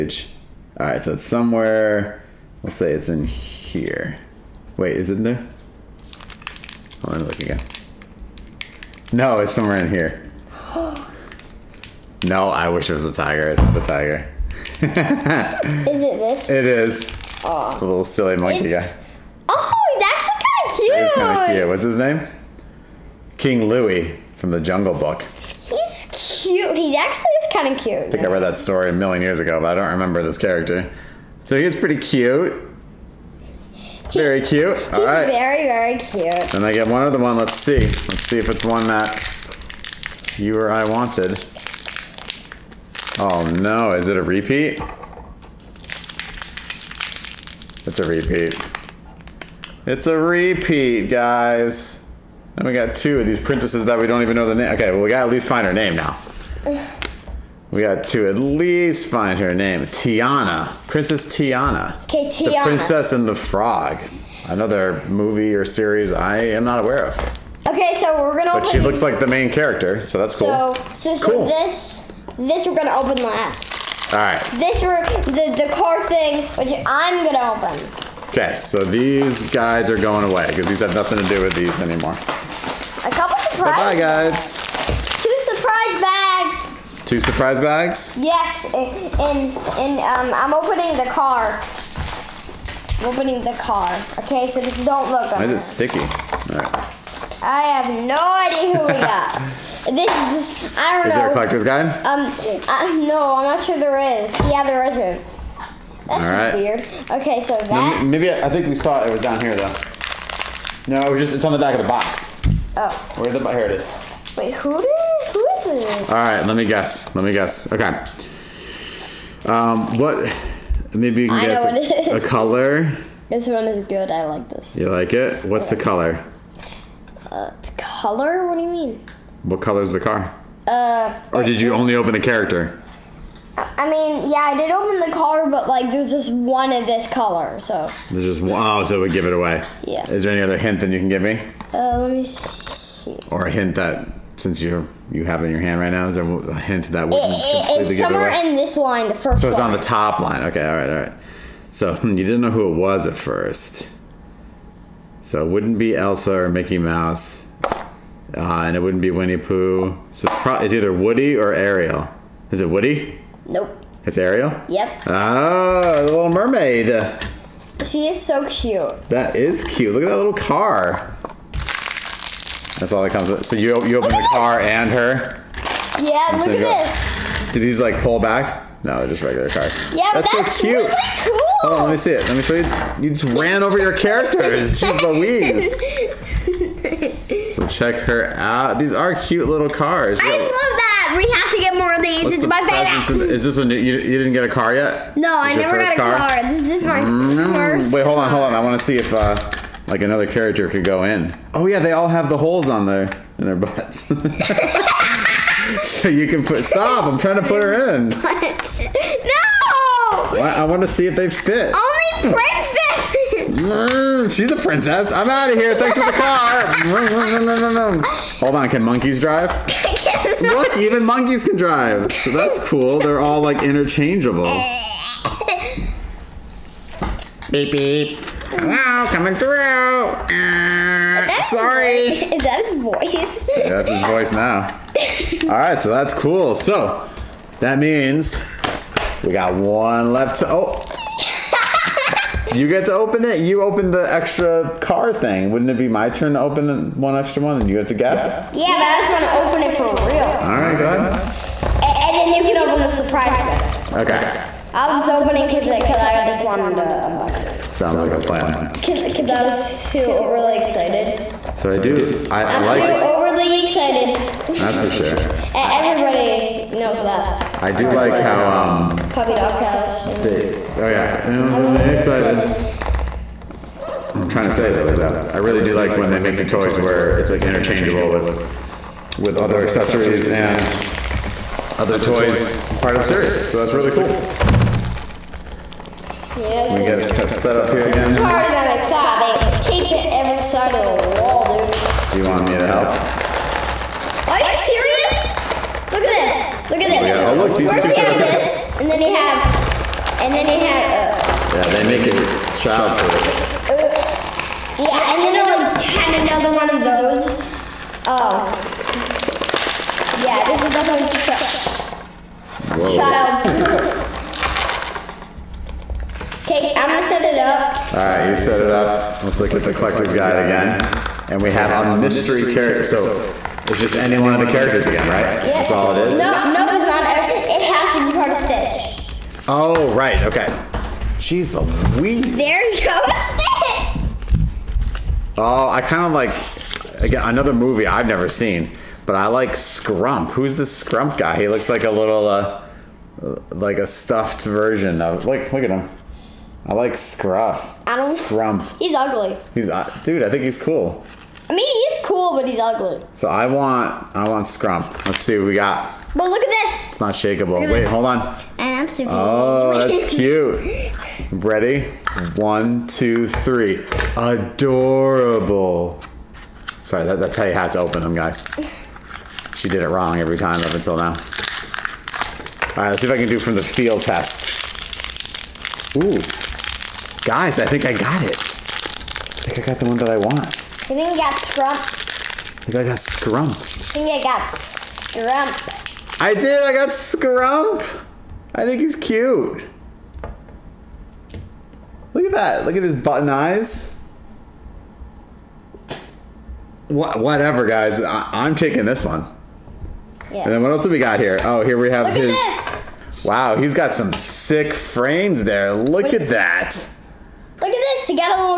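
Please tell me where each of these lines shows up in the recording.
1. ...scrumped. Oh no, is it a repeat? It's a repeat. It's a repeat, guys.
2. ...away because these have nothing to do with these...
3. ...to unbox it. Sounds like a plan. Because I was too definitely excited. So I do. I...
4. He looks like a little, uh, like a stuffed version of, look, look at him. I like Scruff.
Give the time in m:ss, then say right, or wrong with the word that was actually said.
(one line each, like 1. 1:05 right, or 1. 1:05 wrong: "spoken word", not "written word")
1. 0:40 wrong: "wanted", not "scrumped"
2. 1:20 right
3. 4:16 wrong: "overly", not "definitely"
4. 5:41 right.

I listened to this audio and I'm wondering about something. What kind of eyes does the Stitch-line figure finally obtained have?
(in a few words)
button eyes.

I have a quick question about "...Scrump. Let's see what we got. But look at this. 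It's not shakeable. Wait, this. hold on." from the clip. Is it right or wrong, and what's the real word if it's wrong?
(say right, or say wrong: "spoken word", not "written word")
right.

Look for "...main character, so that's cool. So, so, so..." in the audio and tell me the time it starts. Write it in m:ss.
1:09.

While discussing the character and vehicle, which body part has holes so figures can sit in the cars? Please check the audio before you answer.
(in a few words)
butts.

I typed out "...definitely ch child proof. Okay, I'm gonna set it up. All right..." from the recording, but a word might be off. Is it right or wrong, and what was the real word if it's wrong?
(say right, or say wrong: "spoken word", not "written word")
right.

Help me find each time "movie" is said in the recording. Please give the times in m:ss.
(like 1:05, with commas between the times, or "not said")
1:05, 5:37.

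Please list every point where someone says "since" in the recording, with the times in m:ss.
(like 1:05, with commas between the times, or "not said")
2:24.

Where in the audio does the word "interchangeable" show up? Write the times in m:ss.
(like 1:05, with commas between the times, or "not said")
3:43, 4:37.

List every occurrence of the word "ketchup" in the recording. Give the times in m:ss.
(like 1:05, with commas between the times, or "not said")
not said.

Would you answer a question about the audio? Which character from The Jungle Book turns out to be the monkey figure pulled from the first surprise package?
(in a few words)
King Louis.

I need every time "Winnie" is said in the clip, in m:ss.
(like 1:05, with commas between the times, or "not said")
2:39.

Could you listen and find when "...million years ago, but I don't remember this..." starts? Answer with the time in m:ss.
0:28.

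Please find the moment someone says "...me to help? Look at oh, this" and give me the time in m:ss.
4:52.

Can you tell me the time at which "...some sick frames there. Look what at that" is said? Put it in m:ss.
6:43.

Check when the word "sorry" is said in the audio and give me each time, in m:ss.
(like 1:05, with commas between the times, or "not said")
3:51, 6:06.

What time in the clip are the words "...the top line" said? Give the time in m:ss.
2:29.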